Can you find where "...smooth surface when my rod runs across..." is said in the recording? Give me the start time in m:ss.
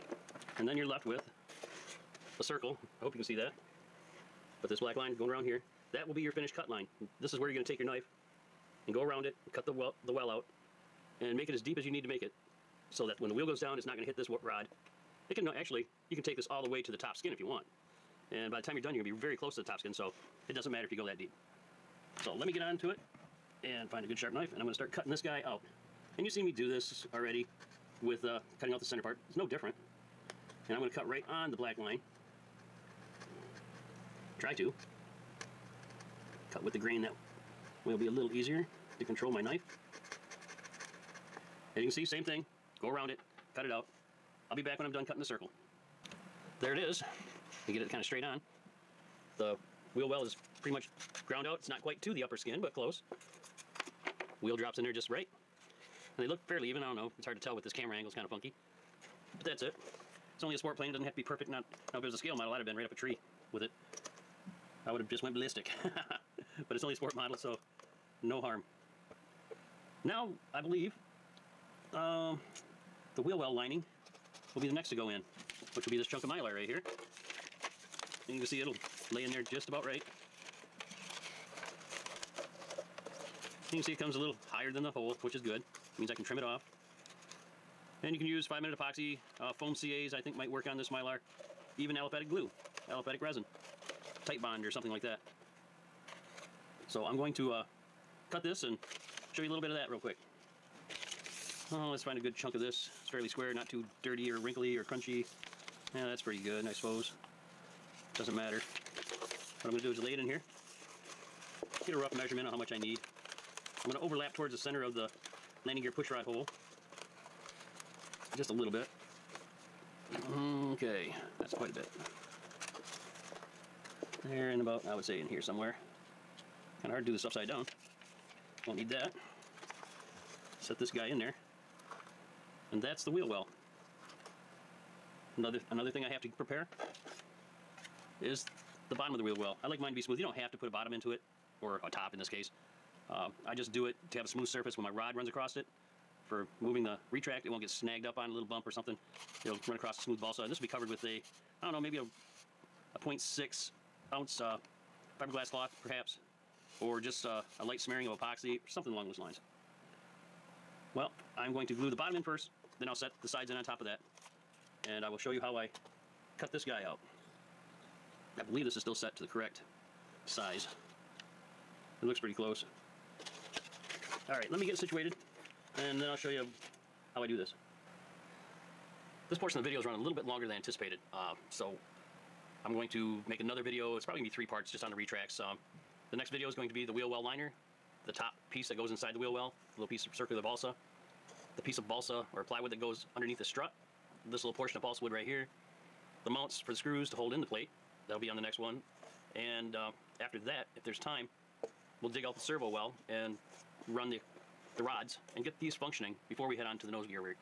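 2:24.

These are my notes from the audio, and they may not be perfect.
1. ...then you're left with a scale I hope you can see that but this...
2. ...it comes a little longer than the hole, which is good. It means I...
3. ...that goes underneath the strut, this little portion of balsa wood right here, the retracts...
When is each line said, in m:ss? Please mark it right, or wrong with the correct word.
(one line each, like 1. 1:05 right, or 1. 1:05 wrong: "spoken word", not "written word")
1. 0:00 wrong: "circle", not "scale"
2. 1:23 wrong: "higher", not "longer"
3. 3:12 wrong: "mounts", not "retracts".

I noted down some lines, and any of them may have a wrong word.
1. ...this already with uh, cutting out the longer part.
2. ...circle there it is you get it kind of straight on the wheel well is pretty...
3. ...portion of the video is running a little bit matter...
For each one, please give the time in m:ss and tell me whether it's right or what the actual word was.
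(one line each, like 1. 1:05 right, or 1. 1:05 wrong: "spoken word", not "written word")
1. 0:26 wrong: "center", not "longer"
2. 0:45 right
3. 2:59 wrong: "longer", not "matter".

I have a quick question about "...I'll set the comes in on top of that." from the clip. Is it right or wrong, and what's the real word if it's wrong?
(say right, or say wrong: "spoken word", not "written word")
wrong: "sides", not "comes".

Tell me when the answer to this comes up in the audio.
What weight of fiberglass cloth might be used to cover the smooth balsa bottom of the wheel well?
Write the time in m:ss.
2:32.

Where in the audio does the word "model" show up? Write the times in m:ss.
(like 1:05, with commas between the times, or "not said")
1:02, 1:07.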